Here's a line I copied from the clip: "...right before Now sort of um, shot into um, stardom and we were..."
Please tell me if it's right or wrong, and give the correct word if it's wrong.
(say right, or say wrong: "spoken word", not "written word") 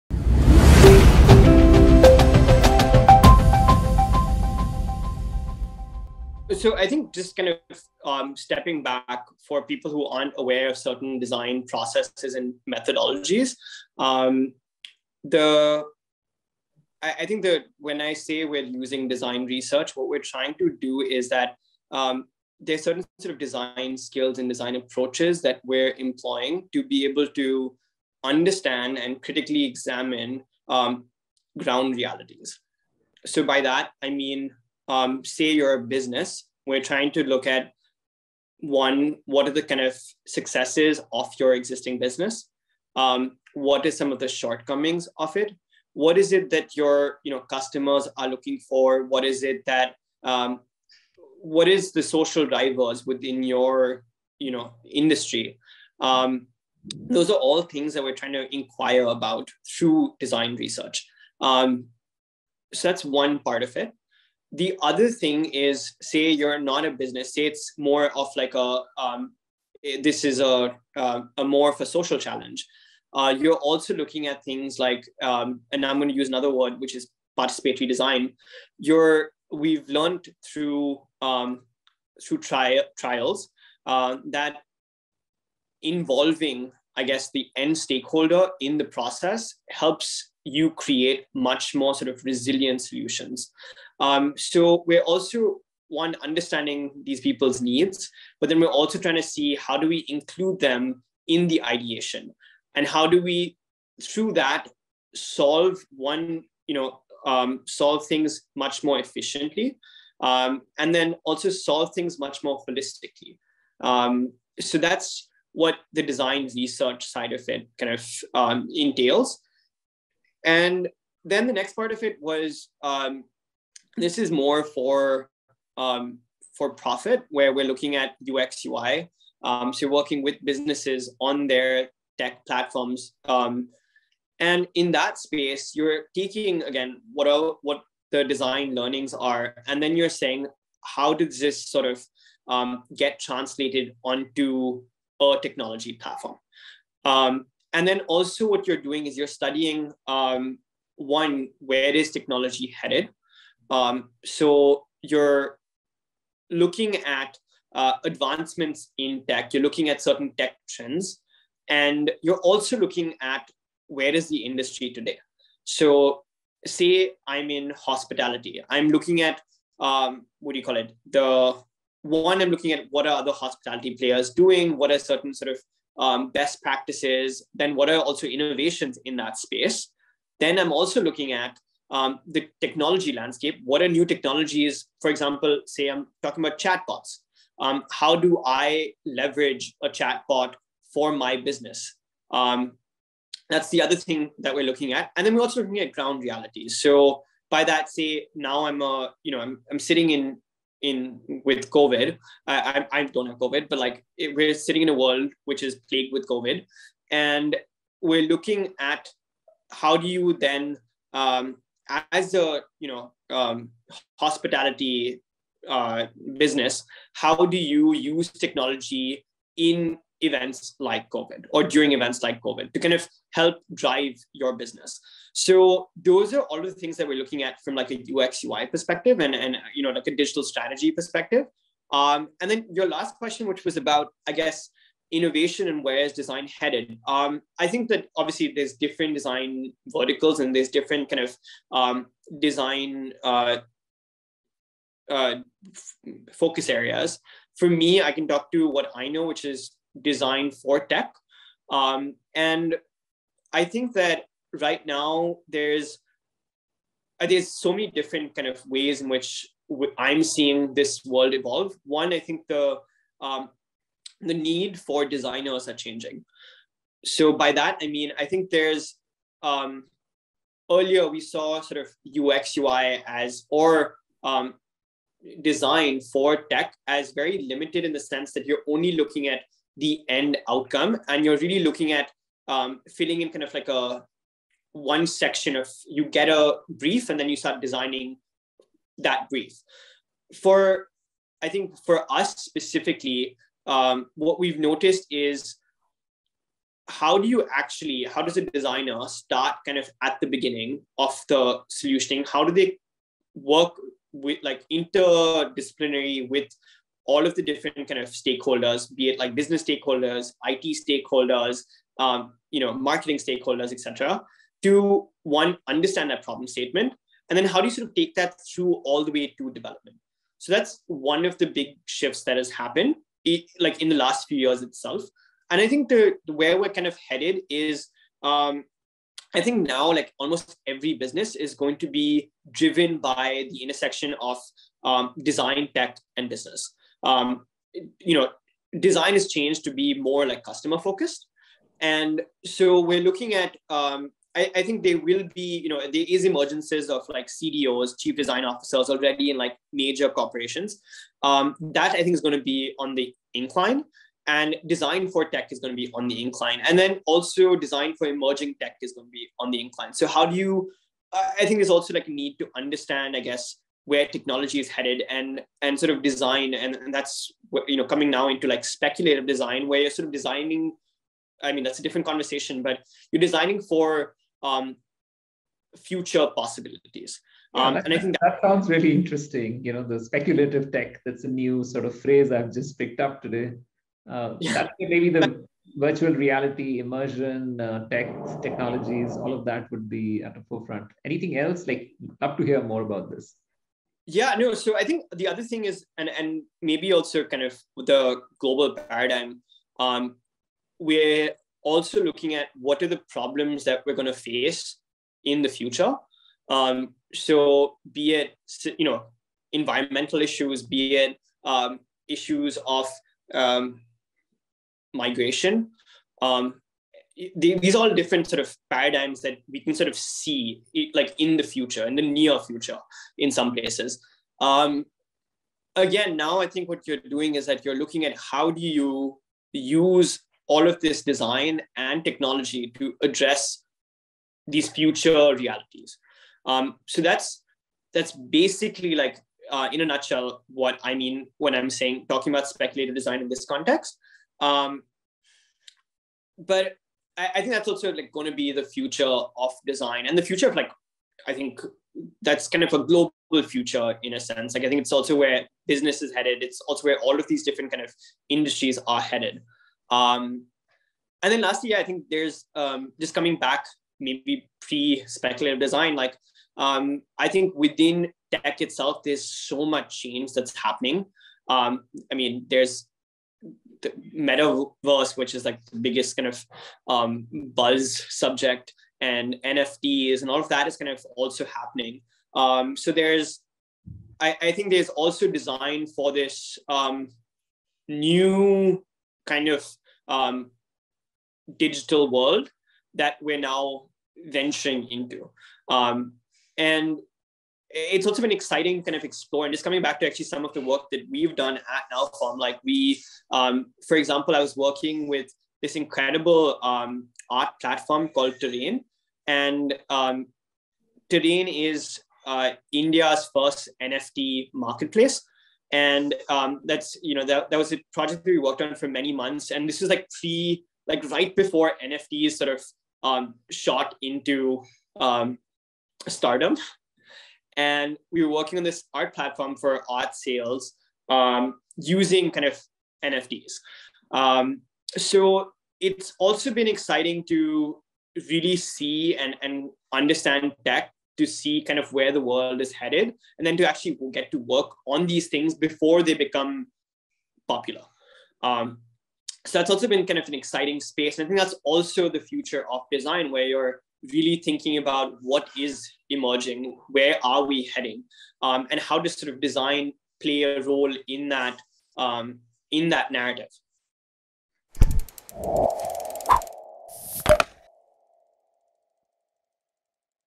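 wrong: "NFTs", not "Now".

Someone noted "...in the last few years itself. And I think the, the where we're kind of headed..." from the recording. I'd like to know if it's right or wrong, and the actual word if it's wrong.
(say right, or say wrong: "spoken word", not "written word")
right.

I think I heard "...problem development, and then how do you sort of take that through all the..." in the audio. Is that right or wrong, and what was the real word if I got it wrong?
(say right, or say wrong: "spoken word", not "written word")
wrong: "statement", not "development".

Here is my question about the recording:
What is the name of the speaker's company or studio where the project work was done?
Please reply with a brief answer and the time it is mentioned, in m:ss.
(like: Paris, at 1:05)
Now Form, at 8:21.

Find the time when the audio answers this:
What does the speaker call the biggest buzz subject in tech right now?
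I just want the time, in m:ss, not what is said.
7:54.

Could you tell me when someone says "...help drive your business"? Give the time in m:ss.
3:43.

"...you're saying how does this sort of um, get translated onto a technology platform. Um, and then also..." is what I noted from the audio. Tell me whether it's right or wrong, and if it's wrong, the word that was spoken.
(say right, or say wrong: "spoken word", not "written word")
right.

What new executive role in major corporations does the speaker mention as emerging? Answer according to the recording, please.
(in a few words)
chief design officers.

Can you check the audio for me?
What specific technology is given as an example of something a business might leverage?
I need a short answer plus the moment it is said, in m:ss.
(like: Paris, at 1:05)
chatbots, at 3:06.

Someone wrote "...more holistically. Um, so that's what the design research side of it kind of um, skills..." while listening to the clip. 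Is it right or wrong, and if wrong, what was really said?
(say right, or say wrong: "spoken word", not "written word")
wrong: "entails", not "skills".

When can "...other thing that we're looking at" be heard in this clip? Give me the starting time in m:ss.
3:13.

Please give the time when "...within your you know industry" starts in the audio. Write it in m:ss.
0:53.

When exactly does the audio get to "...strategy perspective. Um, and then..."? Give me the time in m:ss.
3:50.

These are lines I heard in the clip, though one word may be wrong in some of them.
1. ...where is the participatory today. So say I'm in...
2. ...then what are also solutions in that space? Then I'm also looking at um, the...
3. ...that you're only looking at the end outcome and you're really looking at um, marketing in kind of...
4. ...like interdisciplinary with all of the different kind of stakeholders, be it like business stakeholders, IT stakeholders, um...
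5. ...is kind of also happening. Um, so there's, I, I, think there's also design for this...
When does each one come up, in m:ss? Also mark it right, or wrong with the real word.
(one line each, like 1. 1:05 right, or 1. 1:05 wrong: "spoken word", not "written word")
1. 2:43 wrong: "industry", not "participatory"
2. 2:57 wrong: "innovations", not "solutions"
3. 4:38 wrong: "filling", not "marketing"
4. 5:04 right
5. 8:00 right.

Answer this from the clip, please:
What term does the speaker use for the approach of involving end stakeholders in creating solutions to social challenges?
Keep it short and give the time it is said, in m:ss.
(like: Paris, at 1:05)
participatory design, at 1:17.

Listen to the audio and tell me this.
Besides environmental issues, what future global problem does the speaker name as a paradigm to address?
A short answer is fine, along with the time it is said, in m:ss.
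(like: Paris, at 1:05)
migration, at 6:54.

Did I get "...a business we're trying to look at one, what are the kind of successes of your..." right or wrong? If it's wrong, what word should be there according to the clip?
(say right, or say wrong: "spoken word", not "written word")
right.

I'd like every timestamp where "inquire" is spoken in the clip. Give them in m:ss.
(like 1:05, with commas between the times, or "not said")
0:58.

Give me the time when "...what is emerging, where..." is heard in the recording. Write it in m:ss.
9:15.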